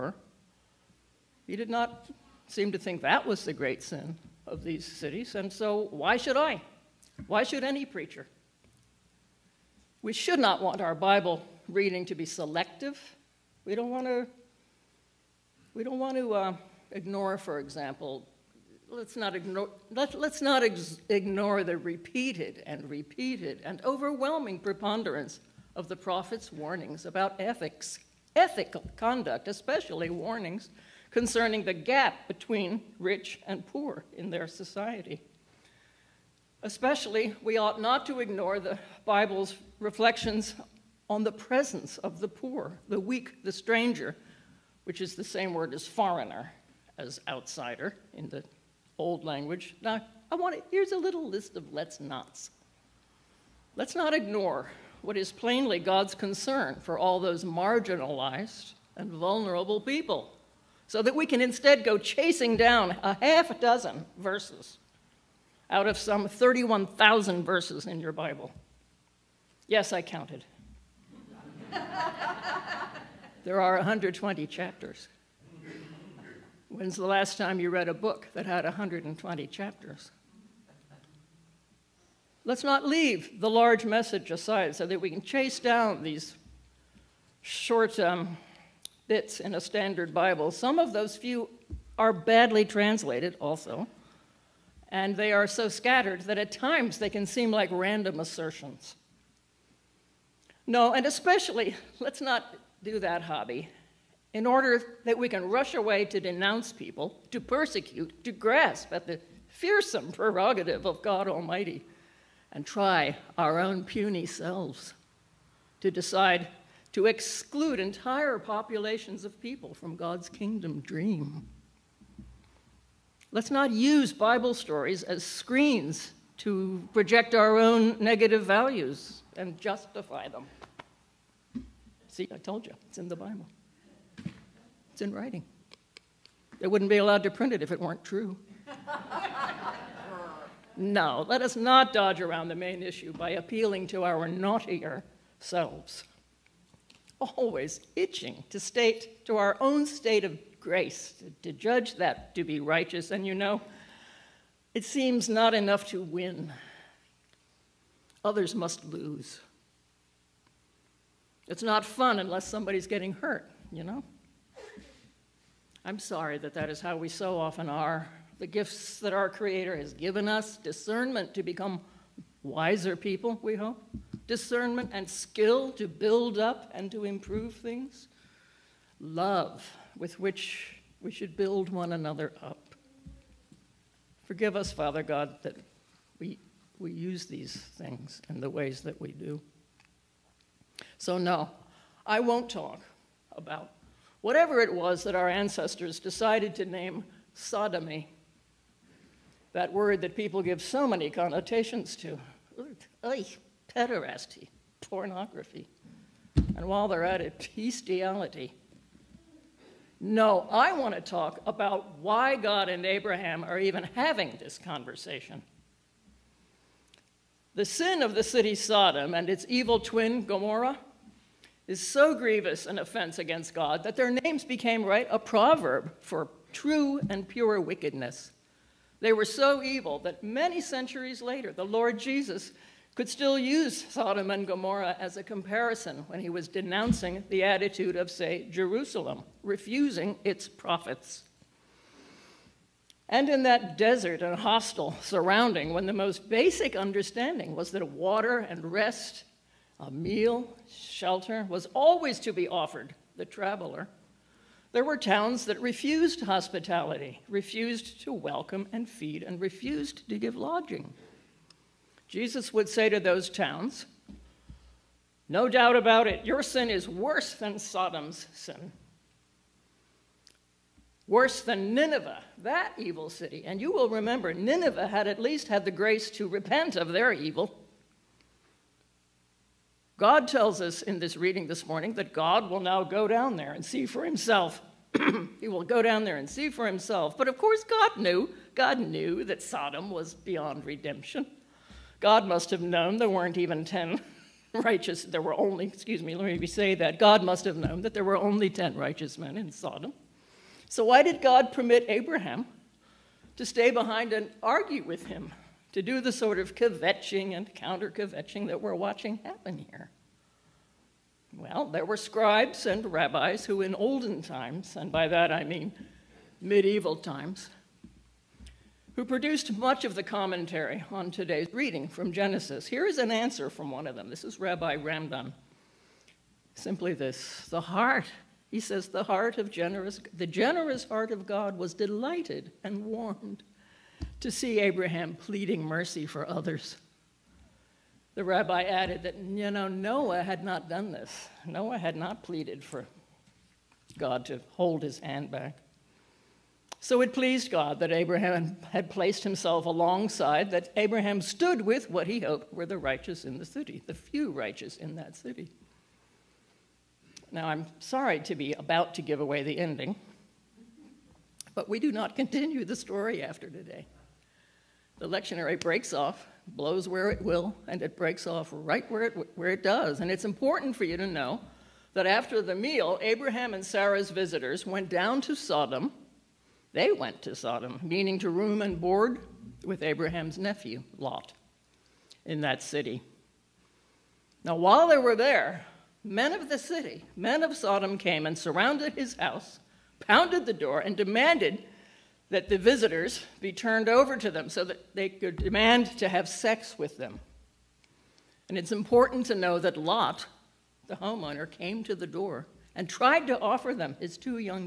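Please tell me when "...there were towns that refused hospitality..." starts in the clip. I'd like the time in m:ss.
4:14.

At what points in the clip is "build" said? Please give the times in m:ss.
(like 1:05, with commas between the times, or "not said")
2:55, 3:01.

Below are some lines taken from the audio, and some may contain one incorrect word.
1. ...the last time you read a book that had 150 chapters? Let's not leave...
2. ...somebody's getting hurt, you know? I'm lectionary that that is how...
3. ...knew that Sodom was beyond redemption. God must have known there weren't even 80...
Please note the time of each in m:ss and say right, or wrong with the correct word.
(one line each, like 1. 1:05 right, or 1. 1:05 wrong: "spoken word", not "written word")
1. 1:16 wrong: "120", not "150"
2. 2:42 wrong: "sorry", not "lectionary"
3. 4:48 wrong: "10", not "80".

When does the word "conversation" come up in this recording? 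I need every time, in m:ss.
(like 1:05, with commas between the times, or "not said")
3:34.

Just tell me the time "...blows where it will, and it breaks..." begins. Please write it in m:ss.
6:06.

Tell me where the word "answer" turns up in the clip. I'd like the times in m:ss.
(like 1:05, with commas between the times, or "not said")
5:23.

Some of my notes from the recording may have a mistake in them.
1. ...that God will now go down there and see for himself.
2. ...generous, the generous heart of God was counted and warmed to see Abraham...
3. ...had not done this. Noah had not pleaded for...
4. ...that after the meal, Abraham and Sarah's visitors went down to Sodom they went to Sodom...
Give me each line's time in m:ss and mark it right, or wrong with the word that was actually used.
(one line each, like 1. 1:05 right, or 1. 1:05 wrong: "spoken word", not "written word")
1. 4:41 right
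2. 5:29 wrong: "delighted", not "counted"
3. 5:40 right
4. 6:11 right.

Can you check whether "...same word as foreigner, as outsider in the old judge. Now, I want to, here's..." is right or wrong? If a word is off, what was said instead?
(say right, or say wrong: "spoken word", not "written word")
wrong: "language", not "judge".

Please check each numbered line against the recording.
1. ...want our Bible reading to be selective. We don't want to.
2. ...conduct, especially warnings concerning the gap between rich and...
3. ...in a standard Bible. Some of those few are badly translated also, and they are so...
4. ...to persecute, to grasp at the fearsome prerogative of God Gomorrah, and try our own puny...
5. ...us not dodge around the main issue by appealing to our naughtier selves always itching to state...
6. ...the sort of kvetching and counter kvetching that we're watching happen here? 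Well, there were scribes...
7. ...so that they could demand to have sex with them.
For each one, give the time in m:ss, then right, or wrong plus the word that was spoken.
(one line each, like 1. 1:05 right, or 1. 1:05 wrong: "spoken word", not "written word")
1. 0:10 right
2. 0:28 right
3. 1:29 right
4. 1:47 wrong: "Almighty", not "Gomorrah"
5. 2:21 right
6. 5:06 right
7. 6:34 right.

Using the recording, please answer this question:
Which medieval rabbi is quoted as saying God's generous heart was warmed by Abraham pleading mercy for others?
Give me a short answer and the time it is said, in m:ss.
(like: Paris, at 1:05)
Ramban, at 5:24.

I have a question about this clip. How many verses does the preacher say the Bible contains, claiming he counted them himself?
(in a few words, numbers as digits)
31,000.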